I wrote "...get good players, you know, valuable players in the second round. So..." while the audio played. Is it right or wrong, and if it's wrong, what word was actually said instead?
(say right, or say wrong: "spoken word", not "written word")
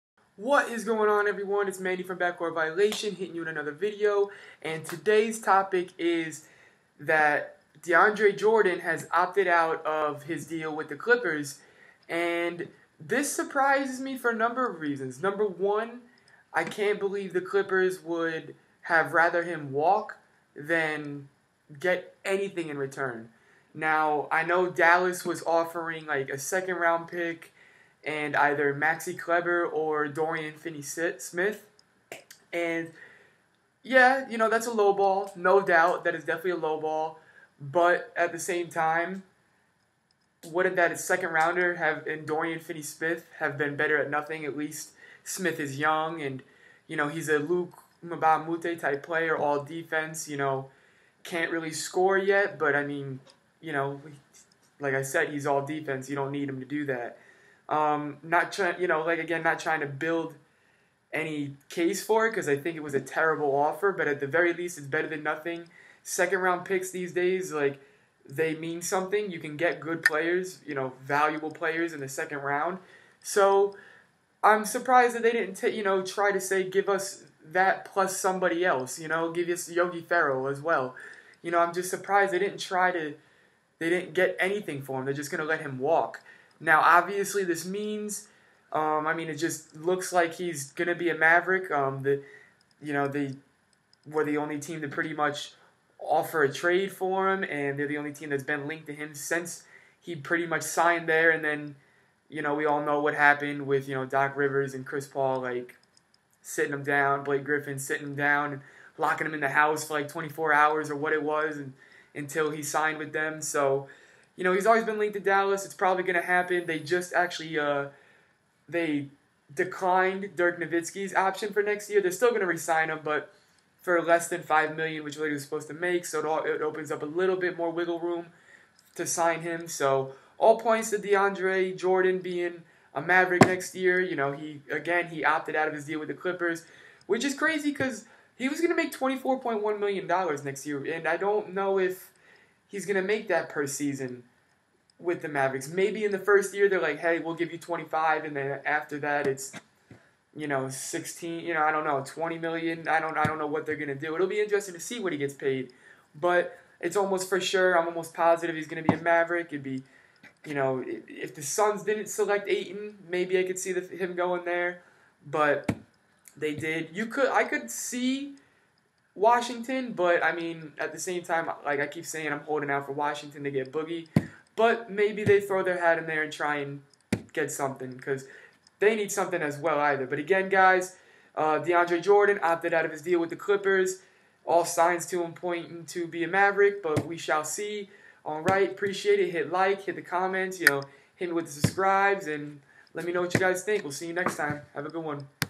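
right.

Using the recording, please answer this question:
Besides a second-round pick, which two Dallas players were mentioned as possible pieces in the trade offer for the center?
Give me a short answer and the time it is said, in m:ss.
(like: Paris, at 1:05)
Maxi Kleber or Dorian Finney-Smith, at 0:28.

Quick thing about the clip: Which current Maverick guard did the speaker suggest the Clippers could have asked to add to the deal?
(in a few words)
Yogi Ferrell.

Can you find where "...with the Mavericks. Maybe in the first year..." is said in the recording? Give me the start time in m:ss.
2:24.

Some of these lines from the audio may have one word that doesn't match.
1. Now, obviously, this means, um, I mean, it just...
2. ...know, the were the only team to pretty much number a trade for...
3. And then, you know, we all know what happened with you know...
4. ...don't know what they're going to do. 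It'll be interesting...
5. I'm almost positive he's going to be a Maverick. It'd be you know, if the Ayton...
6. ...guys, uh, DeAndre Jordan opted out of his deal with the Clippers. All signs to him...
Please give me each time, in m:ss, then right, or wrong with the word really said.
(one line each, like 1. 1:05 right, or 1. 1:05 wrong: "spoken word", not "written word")
1. 1:26 right
2. 1:32 wrong: "offer", not "number"
3. 1:41 right
4. 2:33 right
5. 2:37 wrong: "Suns", not "Ayton"
6. 3:00 right.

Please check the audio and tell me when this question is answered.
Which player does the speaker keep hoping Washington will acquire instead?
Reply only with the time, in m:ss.
2:53.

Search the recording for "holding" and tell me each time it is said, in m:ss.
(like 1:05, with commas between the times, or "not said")
2:52.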